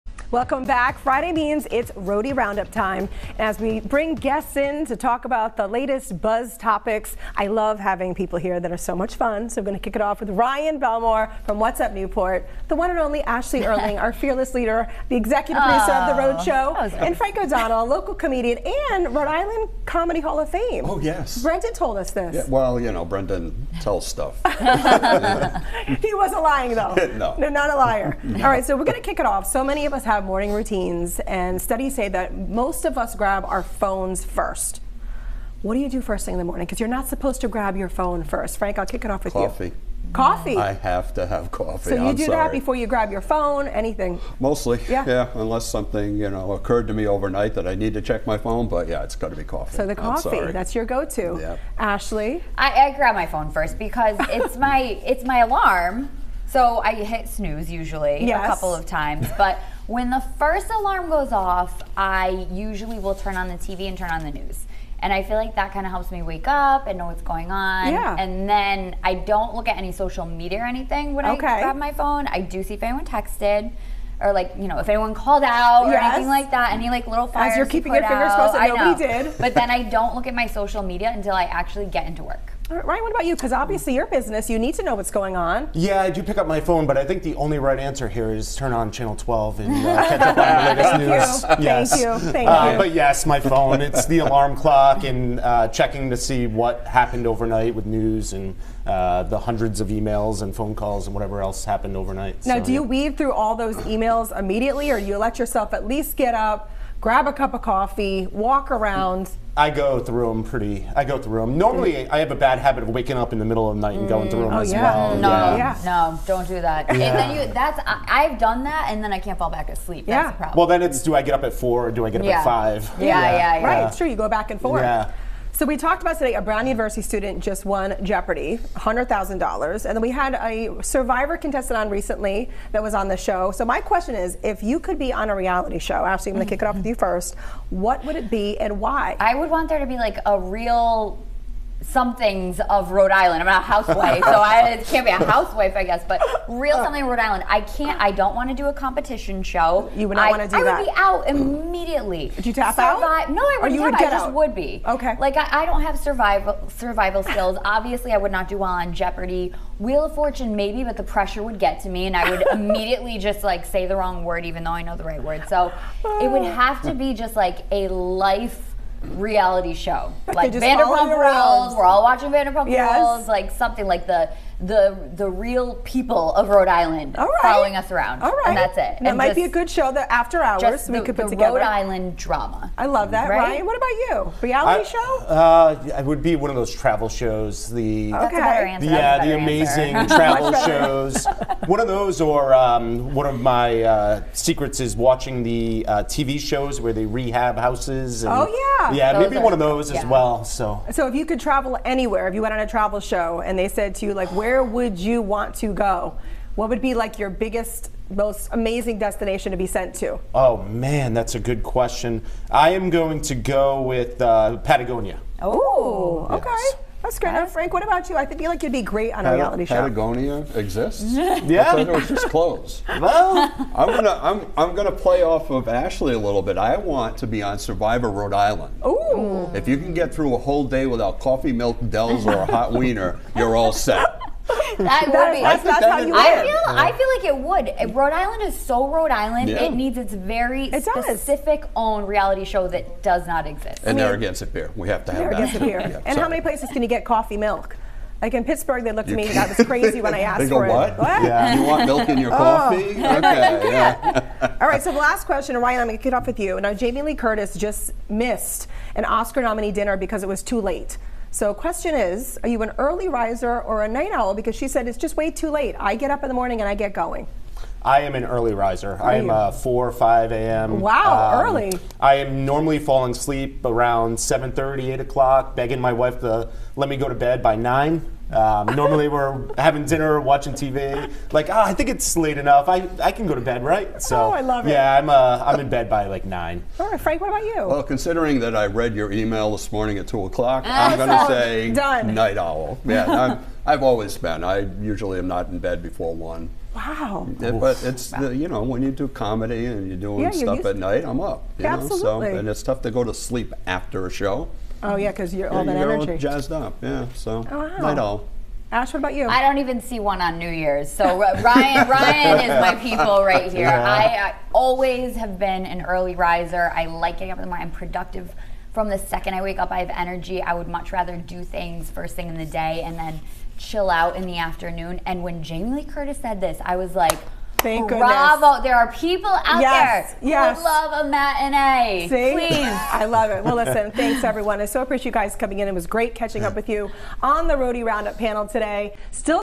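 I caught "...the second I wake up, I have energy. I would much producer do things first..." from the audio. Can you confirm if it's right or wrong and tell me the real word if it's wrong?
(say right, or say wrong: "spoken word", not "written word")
wrong: "rather", not "producer".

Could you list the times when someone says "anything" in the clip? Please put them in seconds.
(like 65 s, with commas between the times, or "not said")
43 s, 70 s, 75 s.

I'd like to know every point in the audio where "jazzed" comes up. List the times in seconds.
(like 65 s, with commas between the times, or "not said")
306 s.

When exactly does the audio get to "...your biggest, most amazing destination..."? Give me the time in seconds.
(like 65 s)
207 s.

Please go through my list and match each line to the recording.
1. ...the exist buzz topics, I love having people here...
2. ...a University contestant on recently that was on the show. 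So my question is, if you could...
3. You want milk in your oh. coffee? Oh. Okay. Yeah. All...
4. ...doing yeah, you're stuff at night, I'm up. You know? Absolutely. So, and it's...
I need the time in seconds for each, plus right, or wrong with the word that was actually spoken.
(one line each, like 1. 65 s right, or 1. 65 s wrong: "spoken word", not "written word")
1. 5 s wrong: "latest", not "exist"
2. 130 s wrong: "Survivor", not "University"
3. 251 s right
4. 299 s right.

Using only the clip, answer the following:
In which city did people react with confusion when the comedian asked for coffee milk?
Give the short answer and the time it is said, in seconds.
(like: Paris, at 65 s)
Pittsburgh, at 248 s.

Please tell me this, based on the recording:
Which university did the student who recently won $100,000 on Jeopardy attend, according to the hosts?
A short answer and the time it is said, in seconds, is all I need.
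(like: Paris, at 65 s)
Brown University, at 126 s.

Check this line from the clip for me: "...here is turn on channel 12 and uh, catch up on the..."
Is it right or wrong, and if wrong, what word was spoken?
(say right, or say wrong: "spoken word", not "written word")
right.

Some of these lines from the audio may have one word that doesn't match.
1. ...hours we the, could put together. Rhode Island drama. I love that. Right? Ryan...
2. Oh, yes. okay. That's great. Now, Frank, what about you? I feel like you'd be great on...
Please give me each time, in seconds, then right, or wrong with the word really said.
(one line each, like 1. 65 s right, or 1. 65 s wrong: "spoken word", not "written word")
1. 180 s right
2. 215 s right.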